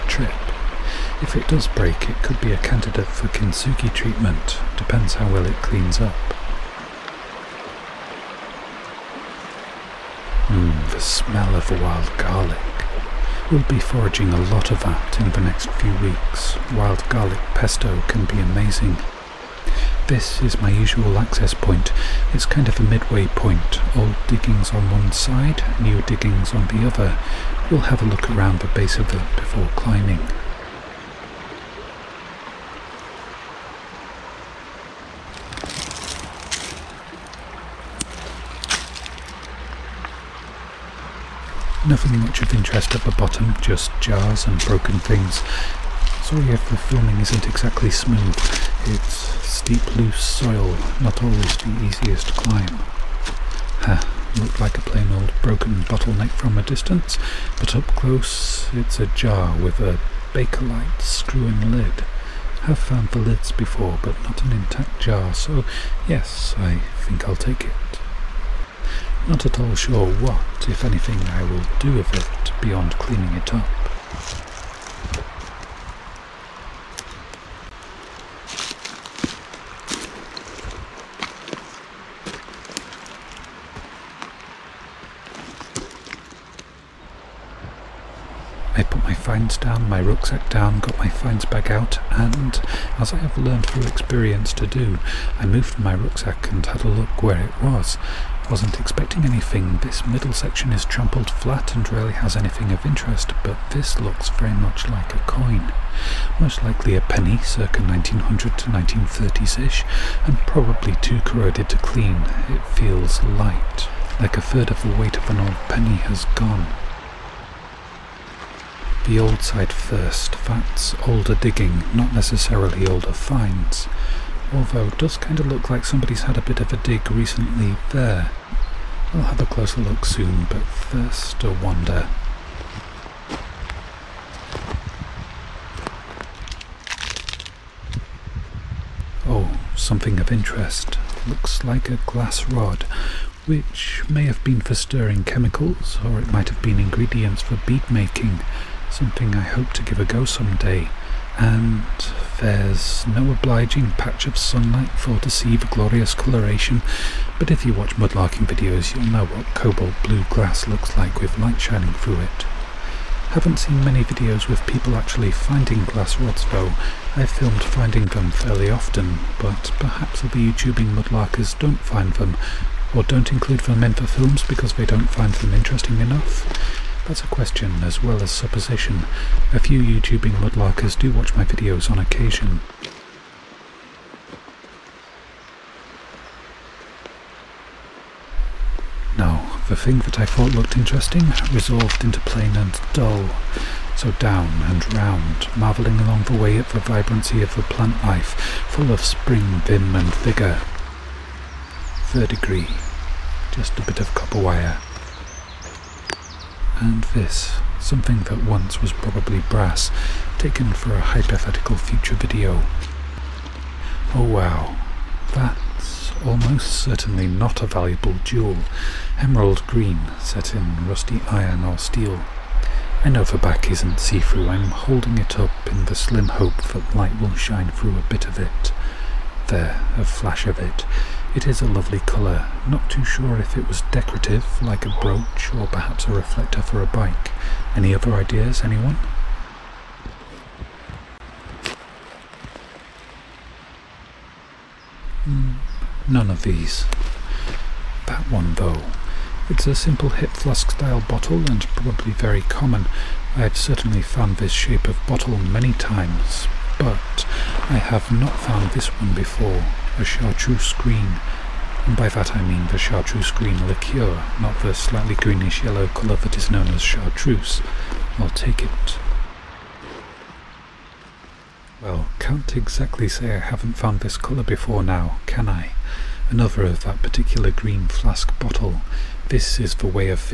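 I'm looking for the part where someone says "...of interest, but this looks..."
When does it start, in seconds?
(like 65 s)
102 s.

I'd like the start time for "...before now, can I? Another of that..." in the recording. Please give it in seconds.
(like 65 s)
274 s.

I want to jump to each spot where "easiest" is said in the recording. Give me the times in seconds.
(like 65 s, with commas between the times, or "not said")
51 s.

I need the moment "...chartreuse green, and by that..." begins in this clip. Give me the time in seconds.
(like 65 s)
260 s.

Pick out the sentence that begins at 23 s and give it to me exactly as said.
Old diggings on one side, new diggings on the other.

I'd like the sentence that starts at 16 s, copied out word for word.
Wild garlic pesto can be amazing.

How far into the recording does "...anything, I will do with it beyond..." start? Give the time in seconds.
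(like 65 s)
70 s.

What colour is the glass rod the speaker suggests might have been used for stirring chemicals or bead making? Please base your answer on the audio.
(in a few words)
cobalt blue.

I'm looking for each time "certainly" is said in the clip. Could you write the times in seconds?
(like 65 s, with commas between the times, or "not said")
216 s, 253 s.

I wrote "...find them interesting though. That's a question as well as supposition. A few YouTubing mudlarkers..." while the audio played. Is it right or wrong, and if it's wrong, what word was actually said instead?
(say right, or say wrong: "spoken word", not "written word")
wrong: "enough", not "though".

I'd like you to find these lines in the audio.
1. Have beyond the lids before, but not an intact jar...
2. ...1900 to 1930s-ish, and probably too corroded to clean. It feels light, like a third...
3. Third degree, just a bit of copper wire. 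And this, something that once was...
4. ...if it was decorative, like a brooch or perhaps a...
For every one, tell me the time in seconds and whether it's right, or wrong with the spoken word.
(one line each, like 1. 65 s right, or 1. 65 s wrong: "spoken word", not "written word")
1. 62 s wrong: "found", not "beyond"
2. 107 s right
3. 202 s right
4. 233 s right.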